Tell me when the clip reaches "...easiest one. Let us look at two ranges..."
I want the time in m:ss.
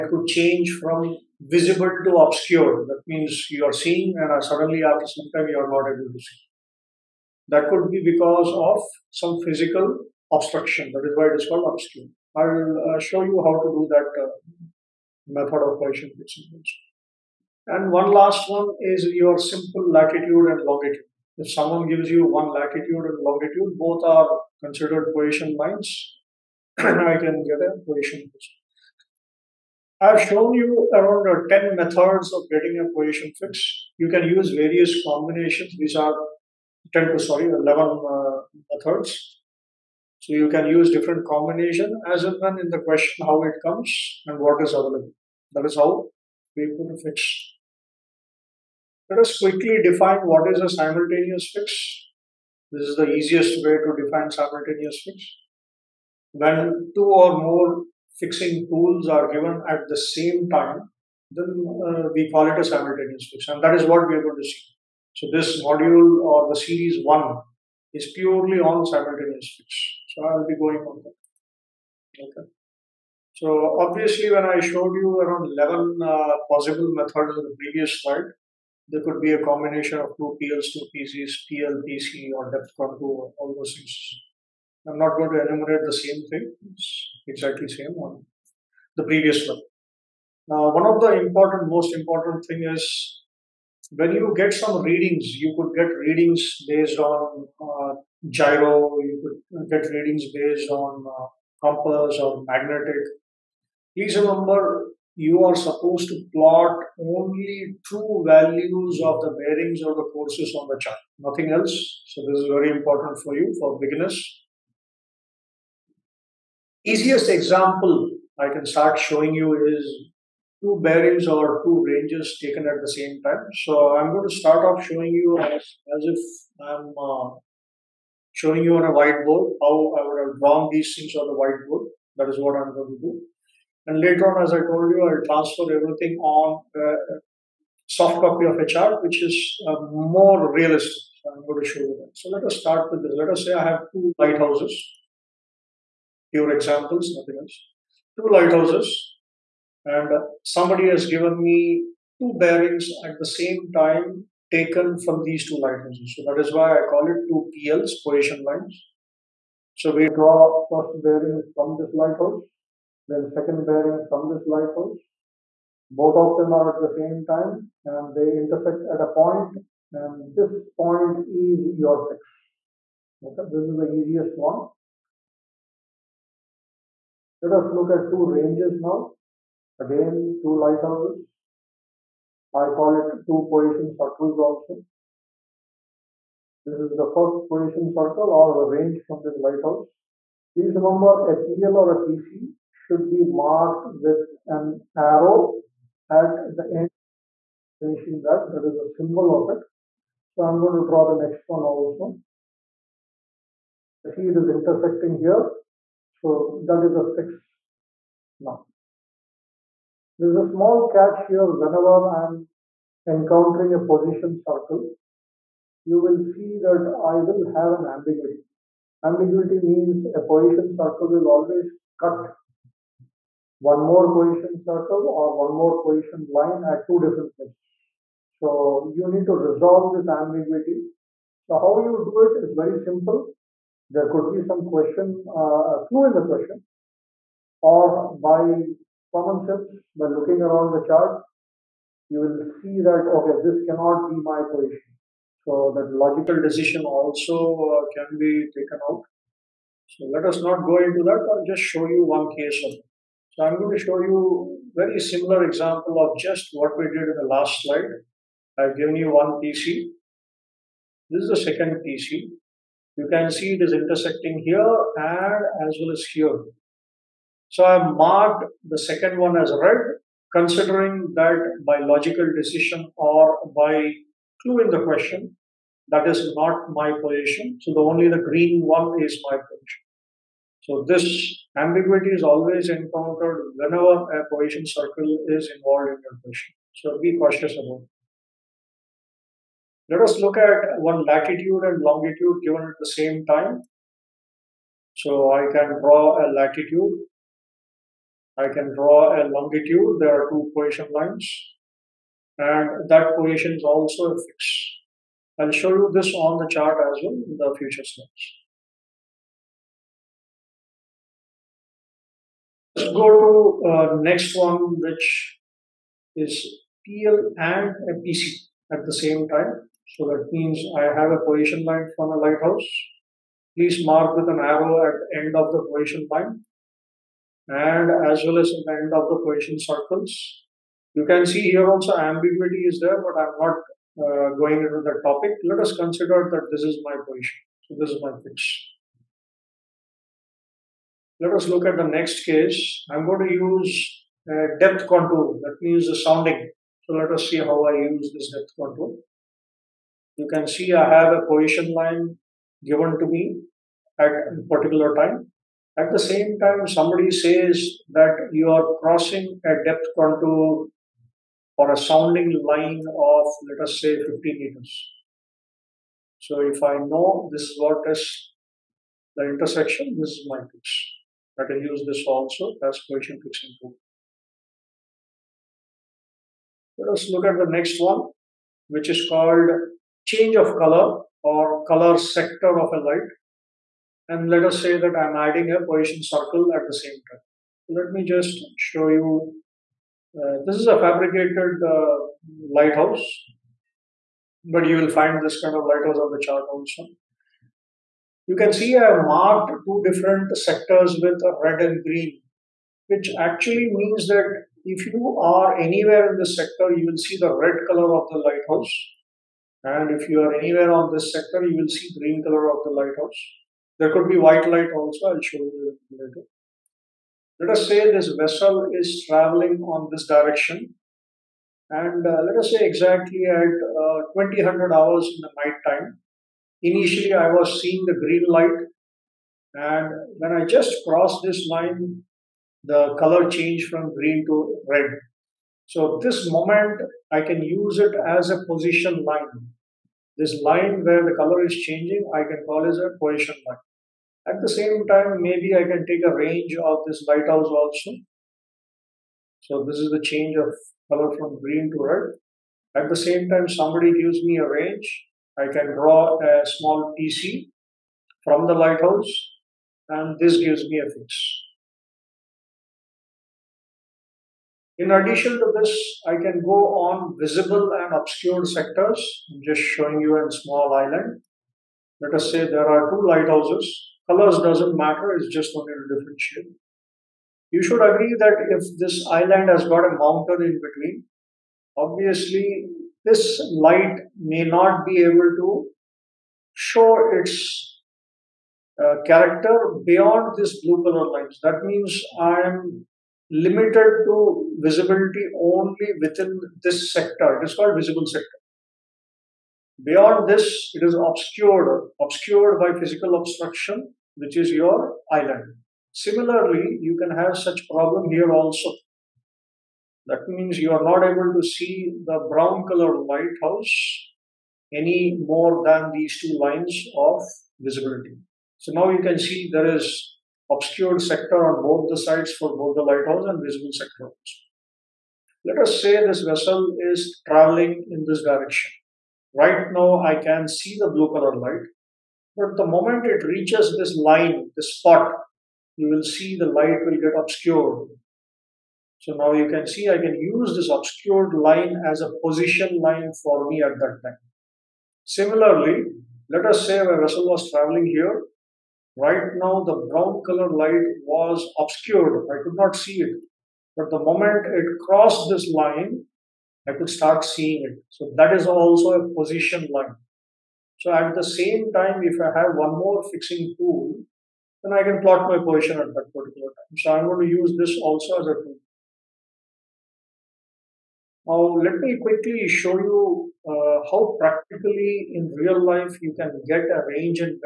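2:53.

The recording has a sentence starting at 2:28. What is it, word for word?
Two lighthouses, and somebody has given me two bearings at the same time taken from these two lighthouses.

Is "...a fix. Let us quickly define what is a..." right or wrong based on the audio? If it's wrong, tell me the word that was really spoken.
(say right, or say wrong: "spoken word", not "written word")
right.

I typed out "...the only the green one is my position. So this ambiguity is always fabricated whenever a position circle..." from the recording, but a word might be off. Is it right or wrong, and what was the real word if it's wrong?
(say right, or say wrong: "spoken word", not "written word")
wrong: "encountered", not "fabricated".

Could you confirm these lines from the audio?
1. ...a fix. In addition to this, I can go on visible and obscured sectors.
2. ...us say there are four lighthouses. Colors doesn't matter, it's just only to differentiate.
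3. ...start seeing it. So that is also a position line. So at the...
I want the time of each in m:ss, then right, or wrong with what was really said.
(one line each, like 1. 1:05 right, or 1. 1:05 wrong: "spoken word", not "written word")
1. 7:40 right
2. 7:52 wrong: "two", not "four"
3. 9:16 right.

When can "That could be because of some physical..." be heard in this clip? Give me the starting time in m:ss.
0:07.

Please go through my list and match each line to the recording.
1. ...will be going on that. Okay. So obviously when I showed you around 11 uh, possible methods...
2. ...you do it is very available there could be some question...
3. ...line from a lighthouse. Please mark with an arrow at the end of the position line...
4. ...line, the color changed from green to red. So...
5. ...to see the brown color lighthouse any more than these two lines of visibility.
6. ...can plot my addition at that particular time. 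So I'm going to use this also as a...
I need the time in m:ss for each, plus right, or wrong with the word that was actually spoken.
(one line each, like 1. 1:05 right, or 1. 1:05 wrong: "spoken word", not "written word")
1. 1:10 right
2. 3:51 wrong: "simple", not "available"
3. 5:21 right
4. 7:11 right
5. 8:31 right
6. 9:24 wrong: "position", not "addition".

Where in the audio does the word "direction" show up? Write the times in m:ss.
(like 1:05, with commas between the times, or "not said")
7:00, 8:48.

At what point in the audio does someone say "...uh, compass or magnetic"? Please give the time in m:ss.
1:41.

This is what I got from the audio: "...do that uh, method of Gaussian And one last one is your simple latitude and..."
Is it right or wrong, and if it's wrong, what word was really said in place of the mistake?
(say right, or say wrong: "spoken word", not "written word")
right.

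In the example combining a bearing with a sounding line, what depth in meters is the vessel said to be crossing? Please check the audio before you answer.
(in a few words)
50 meters.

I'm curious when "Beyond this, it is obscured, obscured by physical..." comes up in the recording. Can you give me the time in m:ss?
8:19.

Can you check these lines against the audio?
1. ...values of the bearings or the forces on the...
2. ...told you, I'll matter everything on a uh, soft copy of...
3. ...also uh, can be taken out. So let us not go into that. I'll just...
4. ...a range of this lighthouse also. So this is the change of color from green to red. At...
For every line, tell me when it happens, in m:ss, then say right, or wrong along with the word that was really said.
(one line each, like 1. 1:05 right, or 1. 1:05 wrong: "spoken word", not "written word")
1. 1:48 right
2. 2:14 wrong: "transfer", not "matter"
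3. 4:06 right
4. 7:26 right.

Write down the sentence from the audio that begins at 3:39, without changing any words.
Ambiguity means a position circle will always cut one more position circle or one more position line at two different places.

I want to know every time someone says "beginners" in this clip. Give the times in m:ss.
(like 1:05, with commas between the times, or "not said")
1:53.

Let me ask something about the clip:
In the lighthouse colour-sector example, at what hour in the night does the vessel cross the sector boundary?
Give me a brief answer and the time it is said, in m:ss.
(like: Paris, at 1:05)
2000 hours, at 7:04.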